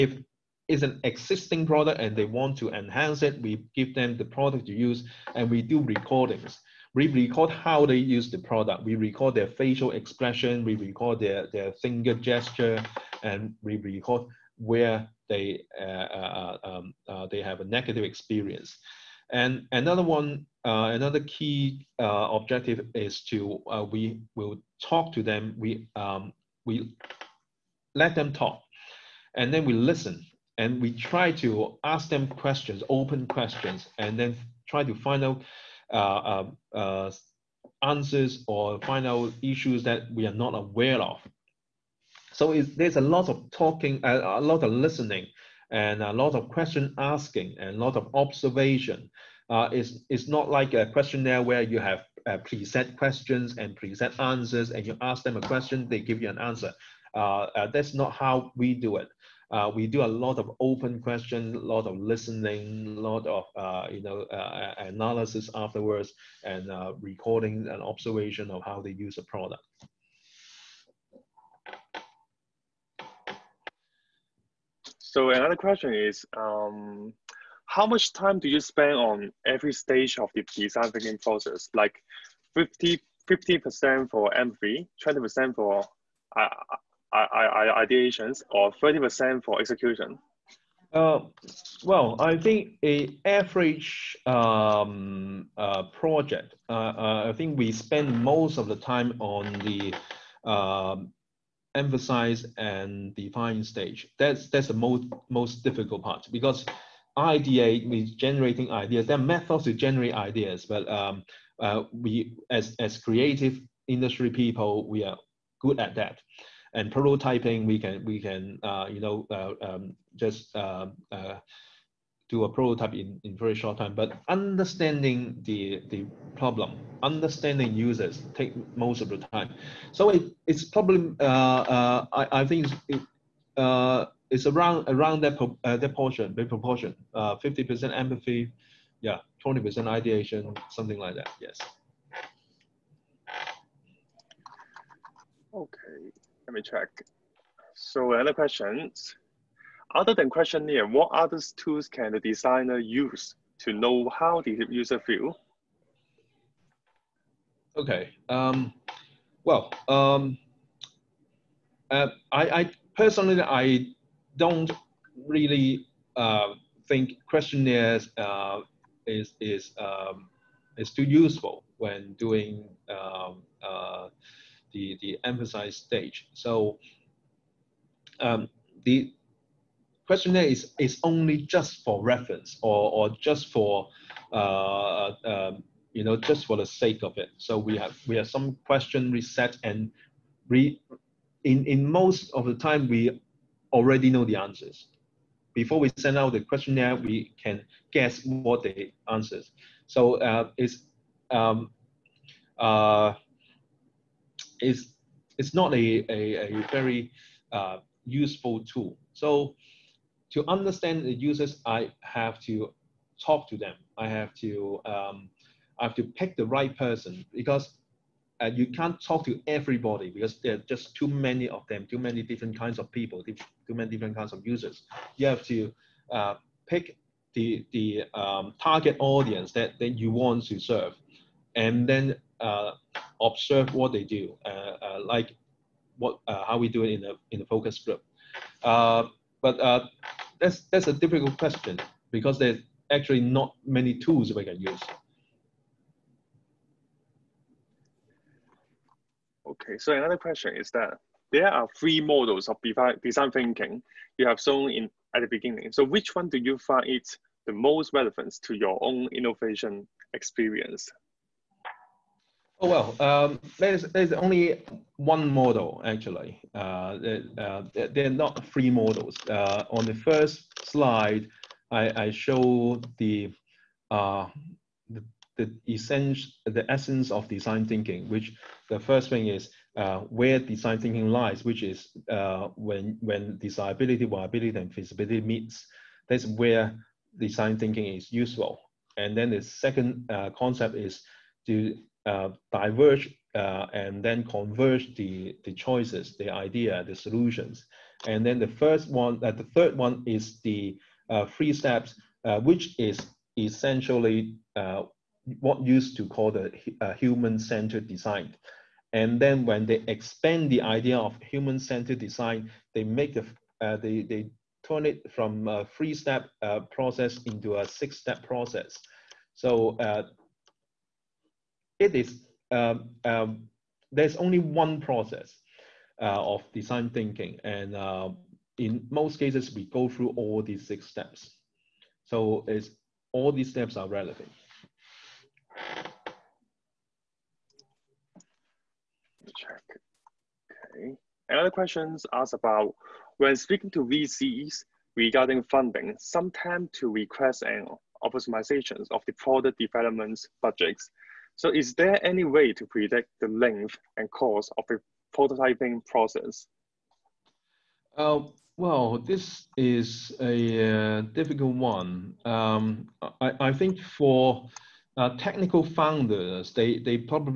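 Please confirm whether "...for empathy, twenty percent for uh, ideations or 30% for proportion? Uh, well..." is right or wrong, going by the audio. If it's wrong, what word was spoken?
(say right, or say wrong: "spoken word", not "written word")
wrong: "execution", not "proportion".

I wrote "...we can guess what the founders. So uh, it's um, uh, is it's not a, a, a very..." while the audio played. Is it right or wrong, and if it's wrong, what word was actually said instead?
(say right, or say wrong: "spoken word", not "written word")
wrong: "answers", not "founders".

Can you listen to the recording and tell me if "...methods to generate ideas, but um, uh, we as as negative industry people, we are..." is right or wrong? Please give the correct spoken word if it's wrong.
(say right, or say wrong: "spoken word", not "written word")
wrong: "creative", not "negative".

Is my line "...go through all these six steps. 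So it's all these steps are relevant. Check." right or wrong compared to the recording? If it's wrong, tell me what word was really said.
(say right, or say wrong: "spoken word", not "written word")
right.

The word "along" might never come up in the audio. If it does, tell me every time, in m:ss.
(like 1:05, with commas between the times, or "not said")
not said.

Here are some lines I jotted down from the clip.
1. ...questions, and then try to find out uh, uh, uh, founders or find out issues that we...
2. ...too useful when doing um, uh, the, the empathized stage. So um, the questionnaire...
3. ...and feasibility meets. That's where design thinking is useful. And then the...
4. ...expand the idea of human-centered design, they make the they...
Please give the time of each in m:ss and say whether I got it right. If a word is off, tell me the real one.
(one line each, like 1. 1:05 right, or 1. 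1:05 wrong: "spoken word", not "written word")
1. 0:33 wrong: "answers", not "founders"
2. 2:50 right
3. 4:44 right
4. 5:09 right.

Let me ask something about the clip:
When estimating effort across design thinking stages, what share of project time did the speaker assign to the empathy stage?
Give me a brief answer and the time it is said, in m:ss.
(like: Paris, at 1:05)
50 percent, at 2:17.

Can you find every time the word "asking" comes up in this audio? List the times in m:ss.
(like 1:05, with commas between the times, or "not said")
0:46.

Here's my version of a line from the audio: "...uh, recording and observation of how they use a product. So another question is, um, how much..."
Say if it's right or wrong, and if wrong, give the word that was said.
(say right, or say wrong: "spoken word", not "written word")
right.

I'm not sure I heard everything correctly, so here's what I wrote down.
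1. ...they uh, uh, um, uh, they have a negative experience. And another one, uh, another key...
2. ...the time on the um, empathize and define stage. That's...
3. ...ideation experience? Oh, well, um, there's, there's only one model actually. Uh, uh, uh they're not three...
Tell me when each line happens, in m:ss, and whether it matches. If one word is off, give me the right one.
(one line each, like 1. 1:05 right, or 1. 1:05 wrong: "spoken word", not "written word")
1. 0:15 right
2. 1:38 right
3. 4:19 wrong: "innovation", not "ideation".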